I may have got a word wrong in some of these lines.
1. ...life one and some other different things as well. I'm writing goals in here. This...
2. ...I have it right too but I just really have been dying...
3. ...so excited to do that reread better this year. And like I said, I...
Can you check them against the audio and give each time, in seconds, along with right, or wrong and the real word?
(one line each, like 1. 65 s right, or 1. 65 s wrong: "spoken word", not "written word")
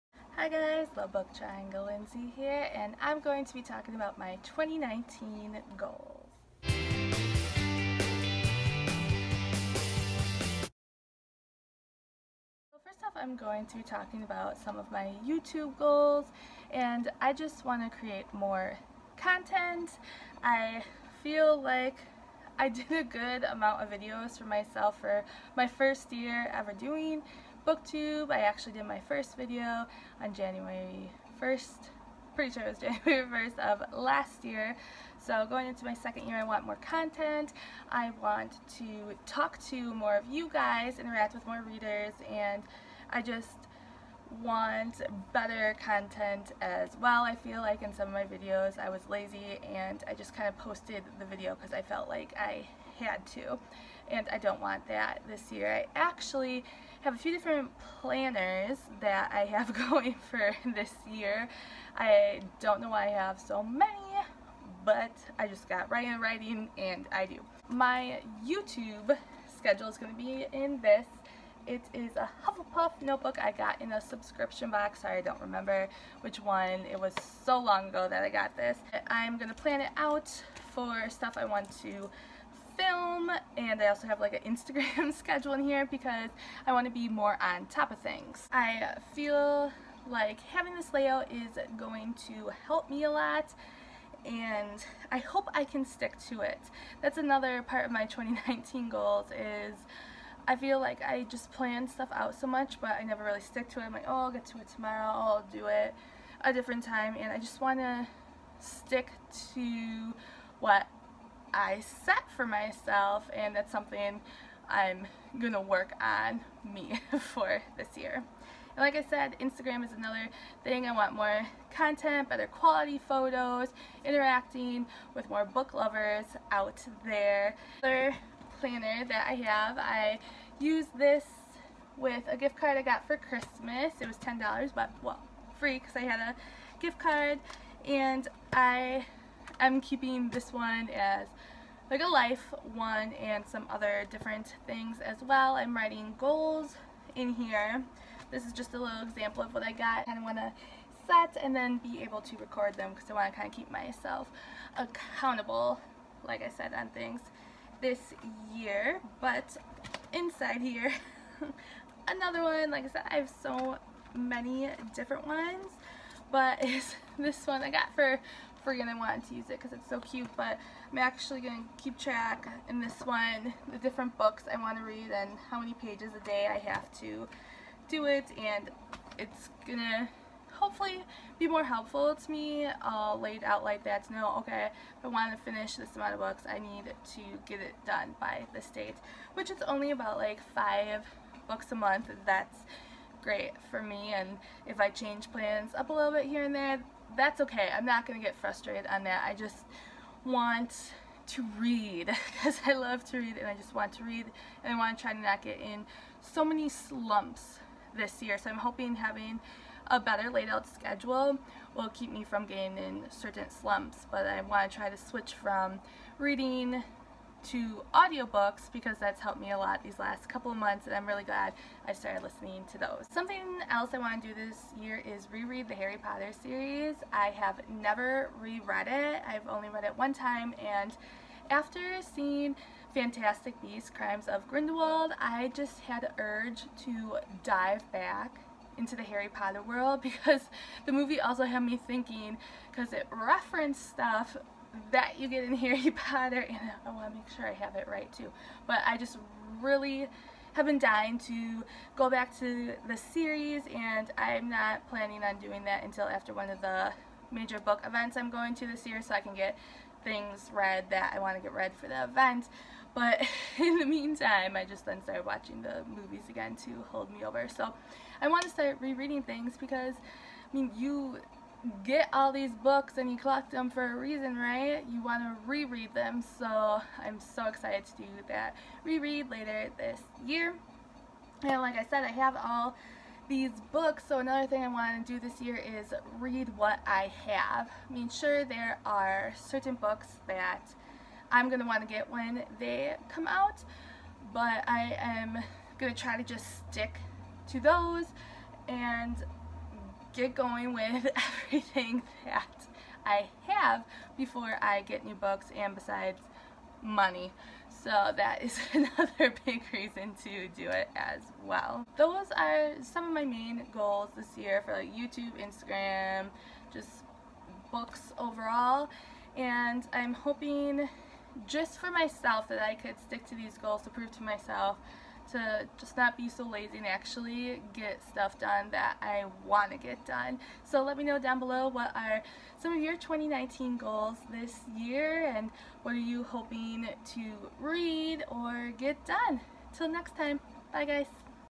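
1. 142 s right
2. 247 s right
3. 277 s wrong: "later", not "better".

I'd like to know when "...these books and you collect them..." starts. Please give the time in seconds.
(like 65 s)
272 s.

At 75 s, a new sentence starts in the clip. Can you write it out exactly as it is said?
Sorry, I don't remember which one.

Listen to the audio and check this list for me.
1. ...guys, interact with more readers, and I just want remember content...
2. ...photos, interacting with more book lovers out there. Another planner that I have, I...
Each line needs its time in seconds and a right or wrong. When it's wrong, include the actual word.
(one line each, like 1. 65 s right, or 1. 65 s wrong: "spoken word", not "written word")
1. 40 s wrong: "better", not "remember"
2. 123 s right.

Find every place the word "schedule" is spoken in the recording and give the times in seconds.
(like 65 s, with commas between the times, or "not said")
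69 s, 85 s, 210 s.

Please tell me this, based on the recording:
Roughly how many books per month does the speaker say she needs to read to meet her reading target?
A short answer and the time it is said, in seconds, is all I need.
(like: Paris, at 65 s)
5, at 190 s.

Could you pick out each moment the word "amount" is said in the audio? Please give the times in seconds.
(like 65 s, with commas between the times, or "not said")
23 s, 185 s.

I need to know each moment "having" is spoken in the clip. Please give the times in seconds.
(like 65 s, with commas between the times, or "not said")
90 s, 208 s.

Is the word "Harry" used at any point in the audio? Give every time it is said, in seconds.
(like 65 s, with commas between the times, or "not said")
225 s, 239 s, 245 s.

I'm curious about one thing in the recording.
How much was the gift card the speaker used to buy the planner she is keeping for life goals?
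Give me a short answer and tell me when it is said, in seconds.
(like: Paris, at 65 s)
$10, at 134 s.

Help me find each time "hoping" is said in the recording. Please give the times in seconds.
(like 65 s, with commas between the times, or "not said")
208 s, 320 s, 336 s.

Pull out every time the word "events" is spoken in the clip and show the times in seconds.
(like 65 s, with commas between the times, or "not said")
257 s, 262 s.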